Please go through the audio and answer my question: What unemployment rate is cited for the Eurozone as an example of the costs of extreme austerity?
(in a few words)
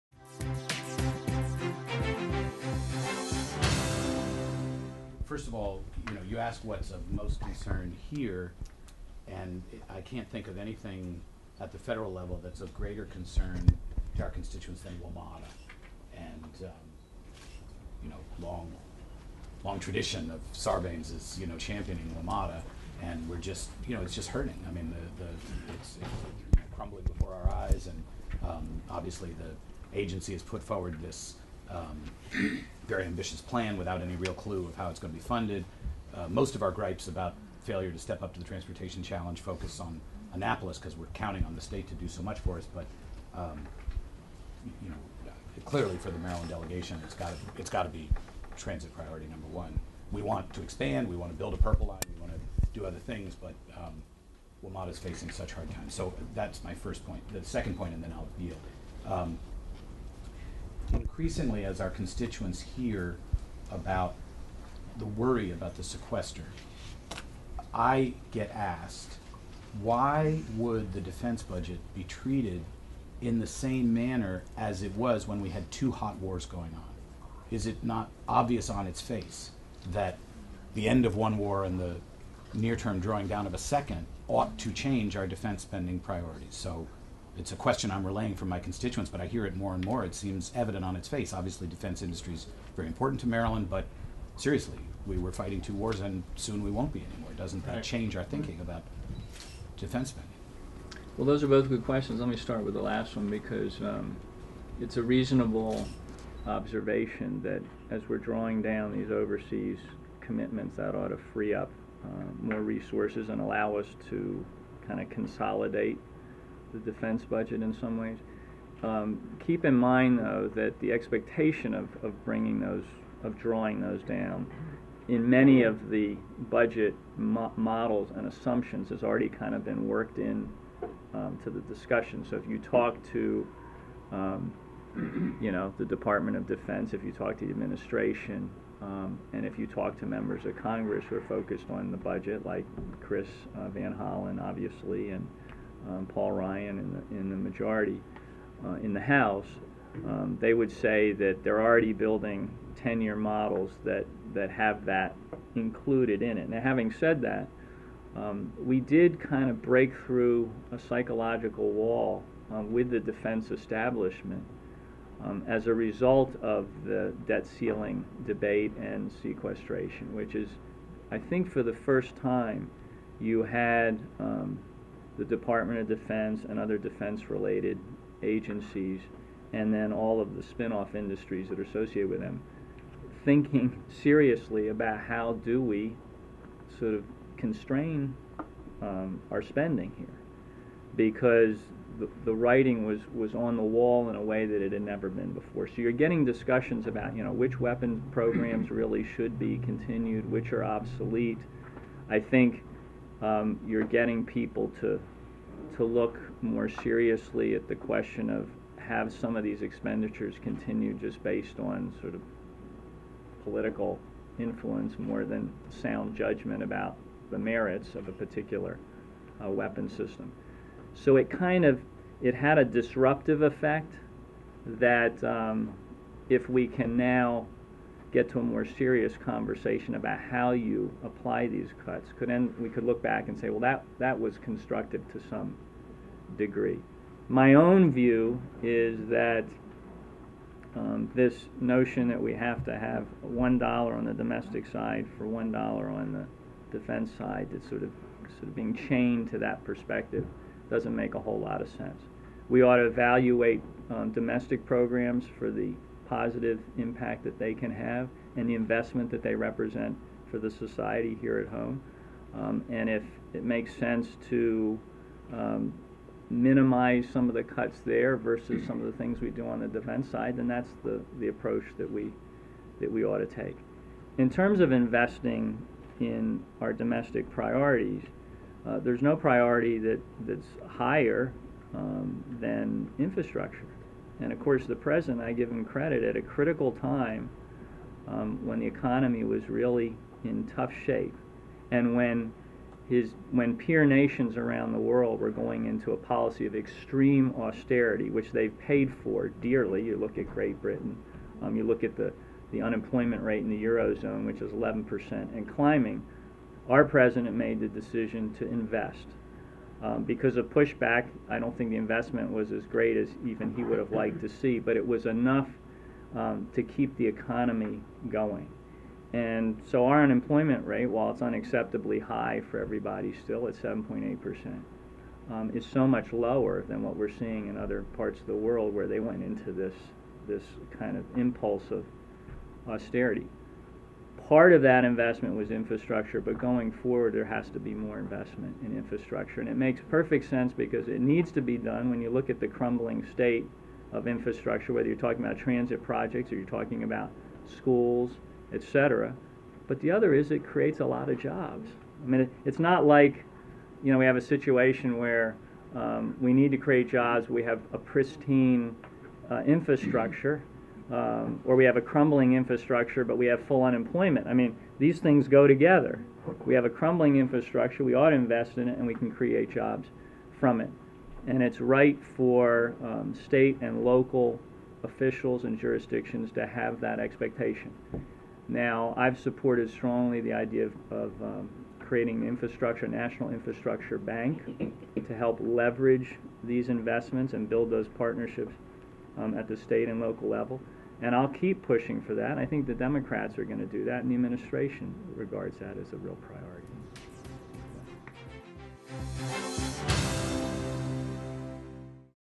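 11%.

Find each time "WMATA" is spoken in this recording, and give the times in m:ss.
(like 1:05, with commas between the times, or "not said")
0:14, 0:22.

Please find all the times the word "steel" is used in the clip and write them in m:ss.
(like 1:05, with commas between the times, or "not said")
not said.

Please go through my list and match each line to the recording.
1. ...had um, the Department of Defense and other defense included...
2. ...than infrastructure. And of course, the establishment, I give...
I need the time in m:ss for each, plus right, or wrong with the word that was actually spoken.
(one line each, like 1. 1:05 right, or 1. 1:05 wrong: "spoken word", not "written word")
1. 2:53 wrong: "related", not "included"
2. 4:42 wrong: "president", not "establishment".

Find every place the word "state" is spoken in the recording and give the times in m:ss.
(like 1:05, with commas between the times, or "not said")
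0:41, 5:43, 6:13, 6:29.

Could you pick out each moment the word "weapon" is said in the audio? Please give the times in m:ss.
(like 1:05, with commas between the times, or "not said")
3:17, 3:39.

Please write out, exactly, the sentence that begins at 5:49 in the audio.
But the other is it creates a lot of jobs.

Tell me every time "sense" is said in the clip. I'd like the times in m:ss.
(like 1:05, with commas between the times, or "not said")
4:11, 4:23, 5:40.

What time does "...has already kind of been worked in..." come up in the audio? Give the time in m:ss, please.
2:08.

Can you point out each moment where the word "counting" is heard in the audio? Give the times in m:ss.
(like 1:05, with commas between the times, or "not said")
0:41.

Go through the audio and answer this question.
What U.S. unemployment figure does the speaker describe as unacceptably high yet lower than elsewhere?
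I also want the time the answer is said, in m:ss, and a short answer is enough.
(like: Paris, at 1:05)
7.8%, at 5:23.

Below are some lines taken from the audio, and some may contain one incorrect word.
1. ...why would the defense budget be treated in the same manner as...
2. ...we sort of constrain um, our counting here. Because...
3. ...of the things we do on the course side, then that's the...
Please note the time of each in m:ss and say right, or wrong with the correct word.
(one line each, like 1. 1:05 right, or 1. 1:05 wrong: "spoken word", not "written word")
1. 1:09 right
2. 3:05 wrong: "spending", not "counting"
3. 4:28 wrong: "defense", not "course".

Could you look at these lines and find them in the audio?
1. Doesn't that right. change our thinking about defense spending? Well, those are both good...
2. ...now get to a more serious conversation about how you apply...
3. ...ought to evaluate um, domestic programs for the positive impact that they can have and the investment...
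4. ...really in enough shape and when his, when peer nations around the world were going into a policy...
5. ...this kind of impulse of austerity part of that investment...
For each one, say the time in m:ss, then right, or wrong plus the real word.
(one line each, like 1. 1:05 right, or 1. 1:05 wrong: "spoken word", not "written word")
1. 1:37 right
2. 3:46 right
3. 4:12 right
4. 4:49 wrong: "tough", not "enough"
5. 5:30 right.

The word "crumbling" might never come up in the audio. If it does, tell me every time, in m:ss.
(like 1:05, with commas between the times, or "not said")
0:26, 5:42, 6:01, 6:06.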